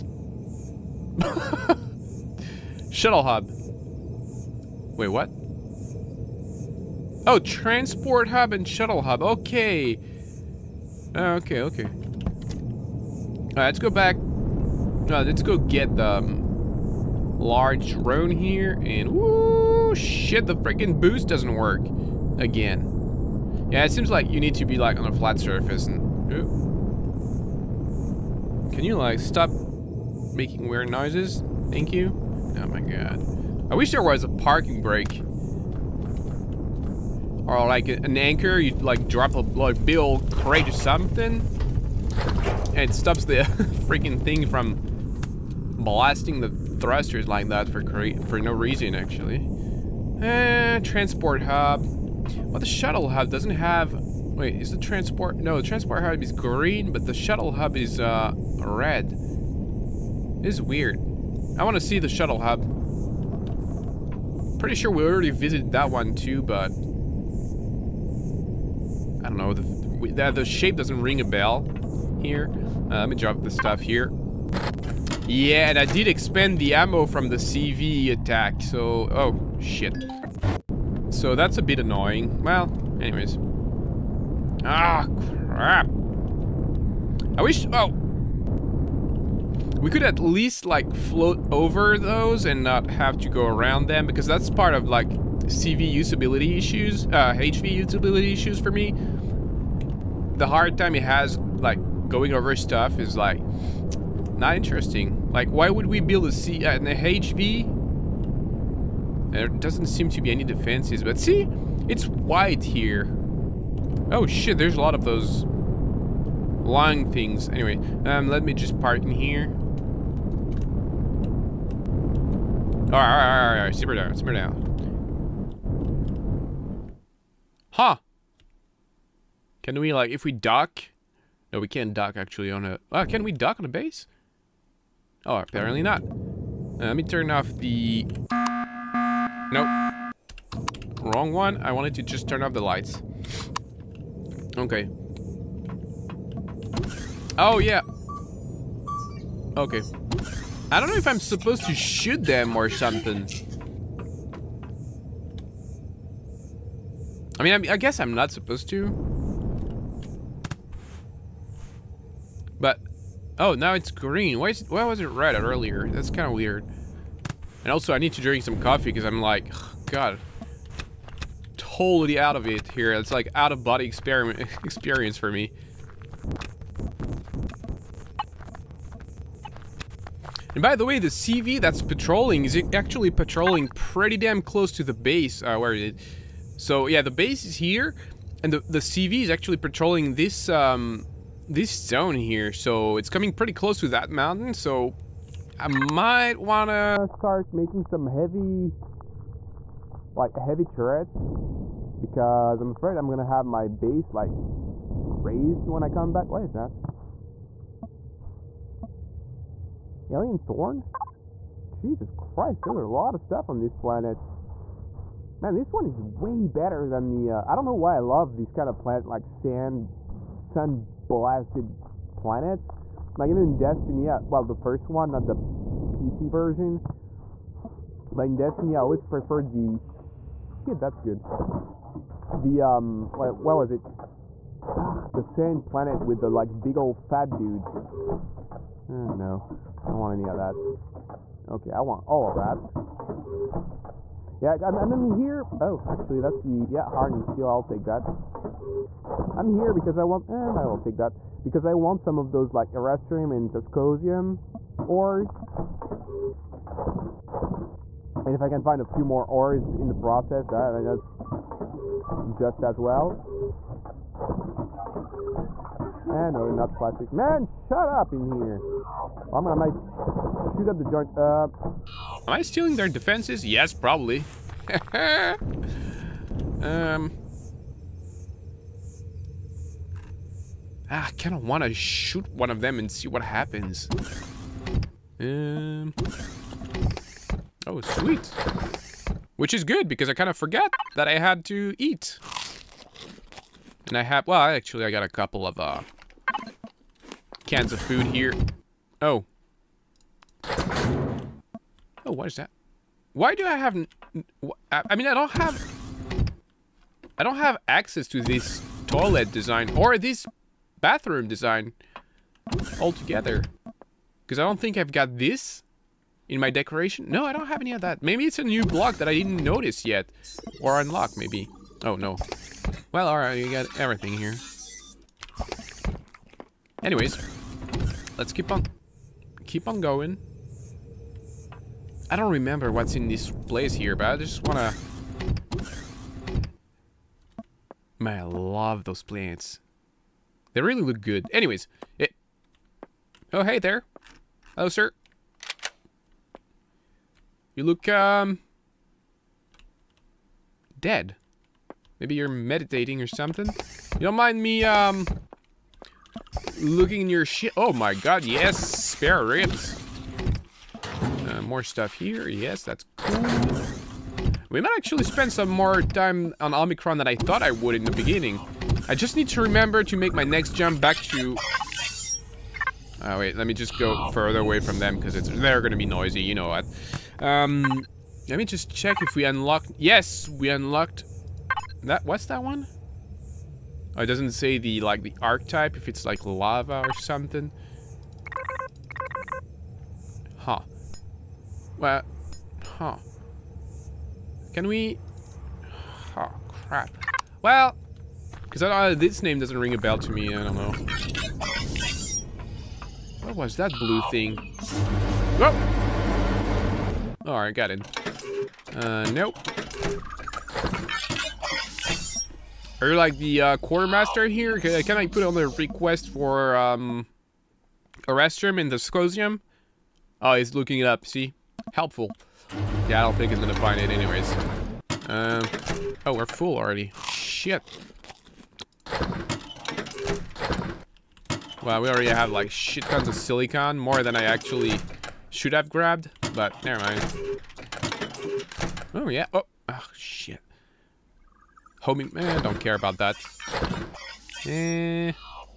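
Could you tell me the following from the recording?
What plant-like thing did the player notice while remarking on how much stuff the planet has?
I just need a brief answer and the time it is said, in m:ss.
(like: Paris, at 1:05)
Alien Thorn, at 3:30.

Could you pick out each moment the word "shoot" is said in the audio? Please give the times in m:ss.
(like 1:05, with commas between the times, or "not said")
2:31, 4:29, 4:41.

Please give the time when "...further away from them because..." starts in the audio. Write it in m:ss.
6:14.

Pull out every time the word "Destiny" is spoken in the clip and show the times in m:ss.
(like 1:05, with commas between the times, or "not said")
3:43, 3:48.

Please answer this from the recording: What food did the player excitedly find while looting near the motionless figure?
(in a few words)
Spare ribs.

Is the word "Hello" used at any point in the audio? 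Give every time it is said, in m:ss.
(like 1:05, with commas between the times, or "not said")
5:44.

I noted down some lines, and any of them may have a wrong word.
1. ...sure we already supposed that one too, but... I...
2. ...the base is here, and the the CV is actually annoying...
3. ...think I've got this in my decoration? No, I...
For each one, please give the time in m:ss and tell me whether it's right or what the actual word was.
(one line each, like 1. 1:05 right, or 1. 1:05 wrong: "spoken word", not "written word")
1. 1:04 wrong: "visited", not "supposed"
2. 3:07 wrong: "patrolling", not "annoying"
3. 5:14 right.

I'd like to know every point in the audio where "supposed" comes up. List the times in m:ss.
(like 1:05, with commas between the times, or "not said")
2:31, 2:38.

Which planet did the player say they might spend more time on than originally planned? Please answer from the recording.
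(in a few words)
Omicron.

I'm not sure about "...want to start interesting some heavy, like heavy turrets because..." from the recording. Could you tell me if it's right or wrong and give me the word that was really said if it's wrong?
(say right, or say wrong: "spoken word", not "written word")
wrong: "making", not "interesting".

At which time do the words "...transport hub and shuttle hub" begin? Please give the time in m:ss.
0:07.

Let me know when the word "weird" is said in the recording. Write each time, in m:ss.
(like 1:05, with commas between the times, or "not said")
0:30, 1:00, 2:46.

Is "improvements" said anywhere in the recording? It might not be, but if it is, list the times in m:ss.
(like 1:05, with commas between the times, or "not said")
not said.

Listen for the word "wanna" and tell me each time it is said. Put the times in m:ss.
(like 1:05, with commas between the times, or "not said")
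5:34.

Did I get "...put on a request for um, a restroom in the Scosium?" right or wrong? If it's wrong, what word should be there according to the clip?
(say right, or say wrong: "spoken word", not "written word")
right.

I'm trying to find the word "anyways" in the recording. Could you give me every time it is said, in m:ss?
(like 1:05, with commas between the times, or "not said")
1:23, 1:57, 5:26, 5:41, 7:03.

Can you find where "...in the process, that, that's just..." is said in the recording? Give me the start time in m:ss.
4:19.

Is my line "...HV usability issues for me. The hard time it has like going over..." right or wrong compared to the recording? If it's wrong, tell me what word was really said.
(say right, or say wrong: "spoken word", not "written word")
right.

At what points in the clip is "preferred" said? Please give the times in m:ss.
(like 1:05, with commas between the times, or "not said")
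3:49.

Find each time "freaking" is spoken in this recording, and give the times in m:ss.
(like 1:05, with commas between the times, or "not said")
0:20, 0:43.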